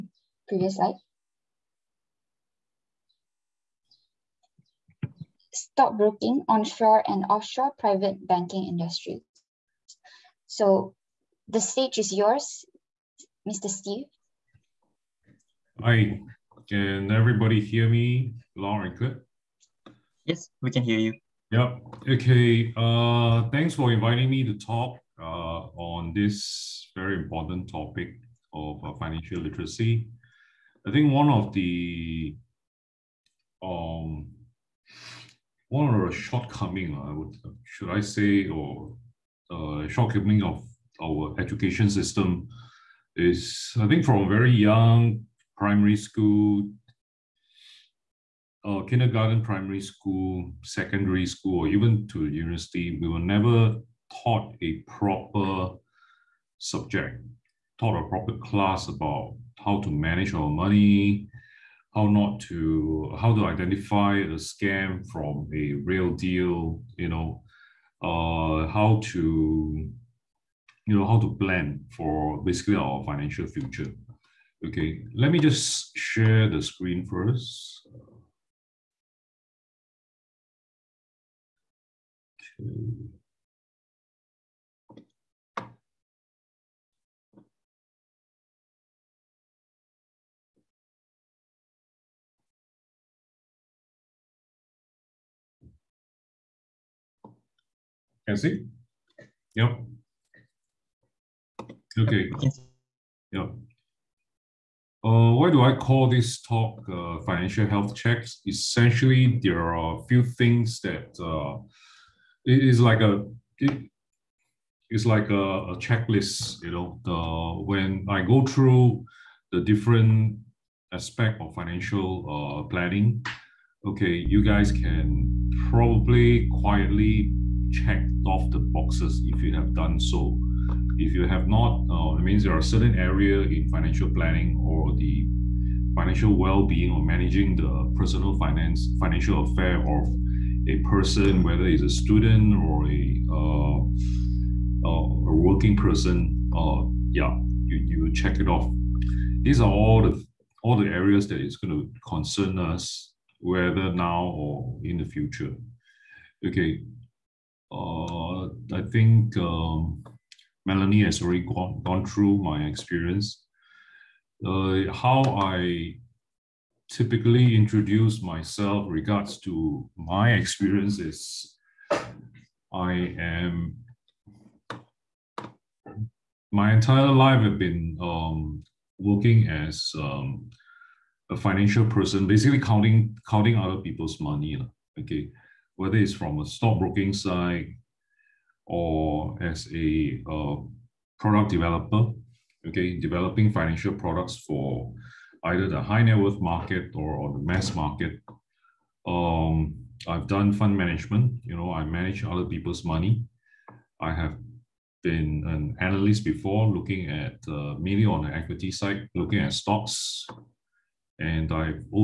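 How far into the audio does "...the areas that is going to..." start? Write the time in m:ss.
2:30.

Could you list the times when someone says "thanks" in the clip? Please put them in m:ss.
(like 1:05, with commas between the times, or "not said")
0:23.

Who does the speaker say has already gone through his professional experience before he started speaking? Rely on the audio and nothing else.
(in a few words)
Melanie.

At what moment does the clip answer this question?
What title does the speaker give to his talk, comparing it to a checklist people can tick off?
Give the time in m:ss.
1:47.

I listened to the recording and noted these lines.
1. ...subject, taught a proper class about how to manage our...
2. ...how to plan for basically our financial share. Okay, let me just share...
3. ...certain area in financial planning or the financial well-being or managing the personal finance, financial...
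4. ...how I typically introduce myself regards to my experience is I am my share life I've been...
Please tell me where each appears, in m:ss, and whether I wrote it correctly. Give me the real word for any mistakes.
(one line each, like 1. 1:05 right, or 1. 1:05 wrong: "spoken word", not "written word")
1. 0:56 right
2. 1:11 wrong: "future", not "share"
3. 2:12 right
4. 2:44 wrong: "entire", not "share".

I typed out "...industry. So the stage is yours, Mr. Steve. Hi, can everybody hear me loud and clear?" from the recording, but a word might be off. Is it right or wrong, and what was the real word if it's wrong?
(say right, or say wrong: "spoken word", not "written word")
right.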